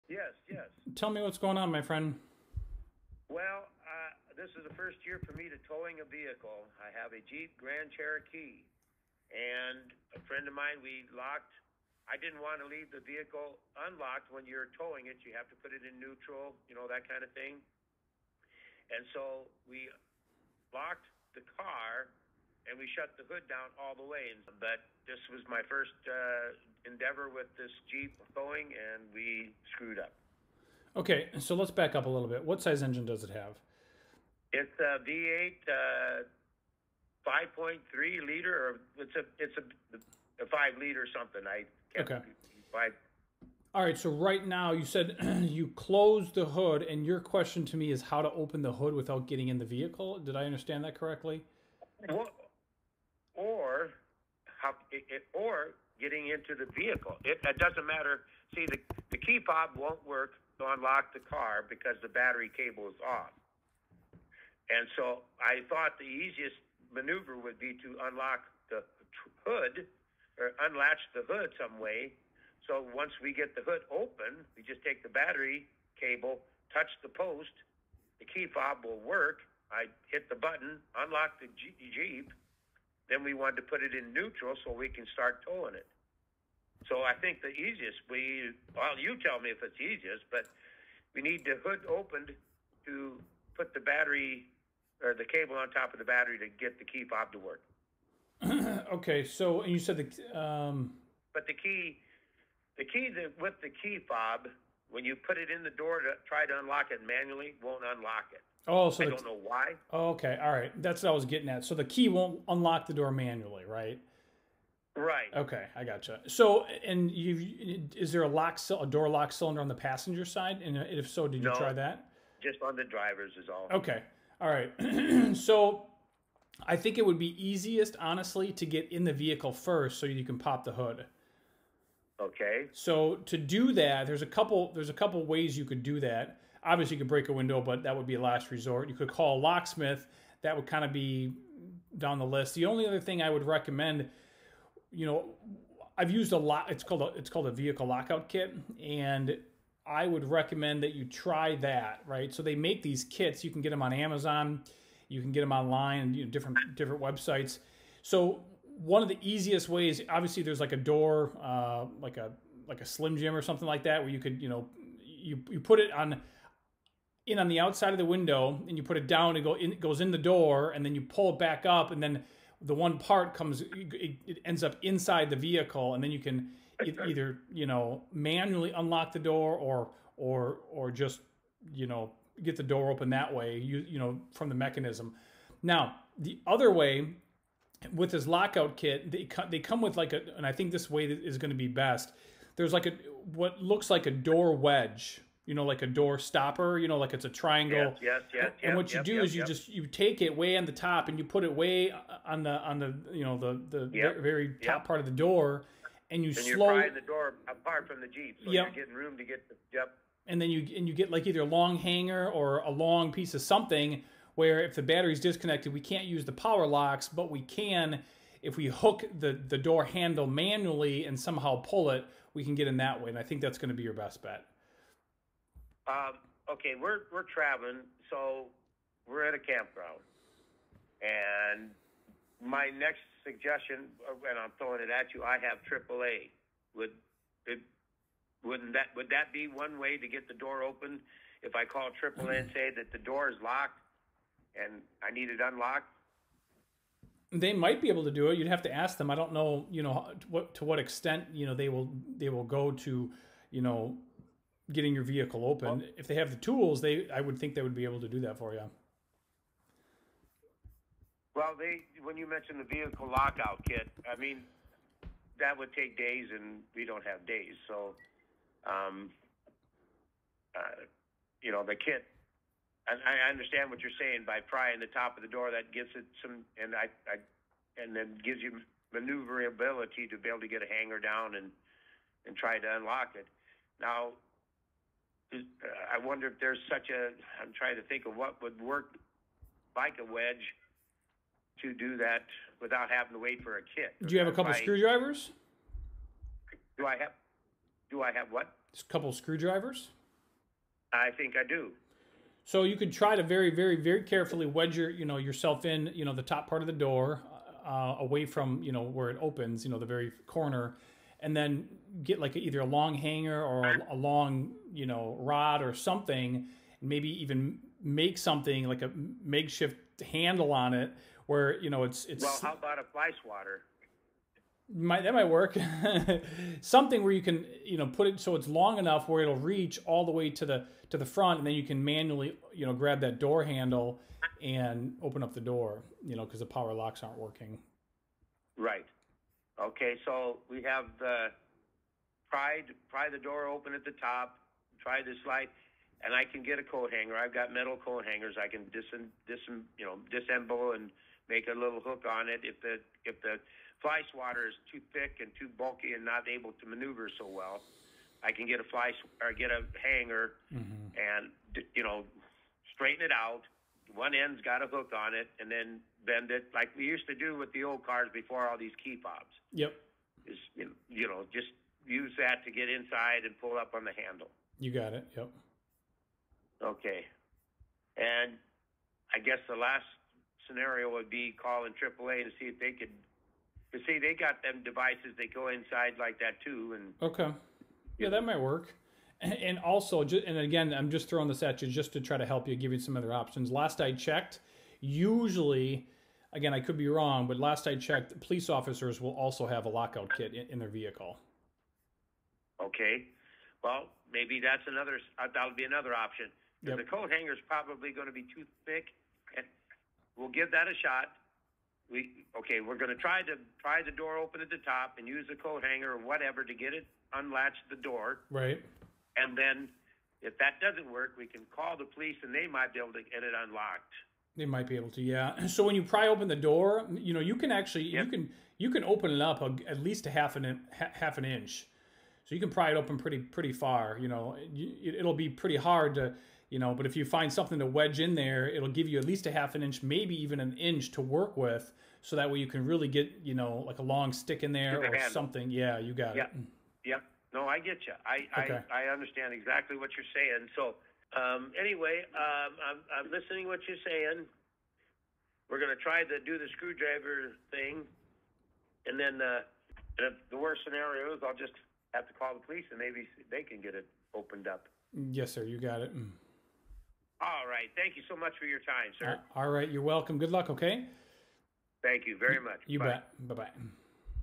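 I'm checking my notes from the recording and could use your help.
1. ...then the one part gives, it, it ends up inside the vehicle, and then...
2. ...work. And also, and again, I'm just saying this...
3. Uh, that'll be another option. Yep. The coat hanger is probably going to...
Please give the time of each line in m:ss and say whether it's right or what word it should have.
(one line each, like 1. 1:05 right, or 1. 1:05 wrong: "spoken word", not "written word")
1. 2:52 wrong: "comes", not "gives"
2. 6:28 wrong: "throwing", not "saying"
3. 6:45 right.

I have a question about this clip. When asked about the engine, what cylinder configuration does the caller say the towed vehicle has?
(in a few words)
V8.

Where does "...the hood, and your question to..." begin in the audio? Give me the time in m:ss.
0:46.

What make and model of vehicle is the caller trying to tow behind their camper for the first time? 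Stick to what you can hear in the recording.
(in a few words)
Jeep Grand Cherokee.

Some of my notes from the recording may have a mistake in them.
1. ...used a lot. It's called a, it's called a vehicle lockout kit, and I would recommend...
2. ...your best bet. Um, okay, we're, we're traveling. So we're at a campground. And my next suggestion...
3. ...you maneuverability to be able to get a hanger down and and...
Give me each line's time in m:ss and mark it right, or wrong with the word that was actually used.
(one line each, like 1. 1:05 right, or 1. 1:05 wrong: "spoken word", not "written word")
1. 2:26 right
2. 3:43 right
3. 4:38 right.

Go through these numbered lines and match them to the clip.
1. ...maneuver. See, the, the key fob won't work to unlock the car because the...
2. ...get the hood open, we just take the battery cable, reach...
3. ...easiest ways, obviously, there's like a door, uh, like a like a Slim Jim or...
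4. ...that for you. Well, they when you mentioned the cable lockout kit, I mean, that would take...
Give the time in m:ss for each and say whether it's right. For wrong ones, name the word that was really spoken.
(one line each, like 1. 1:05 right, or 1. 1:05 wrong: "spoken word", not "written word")
1. 0:57 wrong: "matter", not "maneuver"
2. 1:13 wrong: "touch", not "reach"
3. 2:39 right
4. 4:18 wrong: "vehicle", not "cable".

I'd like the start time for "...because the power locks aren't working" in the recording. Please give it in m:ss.
5:36.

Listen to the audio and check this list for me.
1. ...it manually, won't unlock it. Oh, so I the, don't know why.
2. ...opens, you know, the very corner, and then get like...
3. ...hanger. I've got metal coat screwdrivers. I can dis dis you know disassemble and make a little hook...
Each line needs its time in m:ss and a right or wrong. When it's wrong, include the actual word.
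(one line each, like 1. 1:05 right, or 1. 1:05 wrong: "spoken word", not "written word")
1. 1:46 right
2. 5:09 right
3. 5:46 wrong: "hangers", not "screwdrivers".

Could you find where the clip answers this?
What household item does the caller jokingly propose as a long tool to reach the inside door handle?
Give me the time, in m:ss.
5:22.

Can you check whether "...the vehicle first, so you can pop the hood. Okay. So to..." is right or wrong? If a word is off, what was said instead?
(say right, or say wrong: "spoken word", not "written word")
right.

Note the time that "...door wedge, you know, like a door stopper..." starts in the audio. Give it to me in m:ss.
3:14.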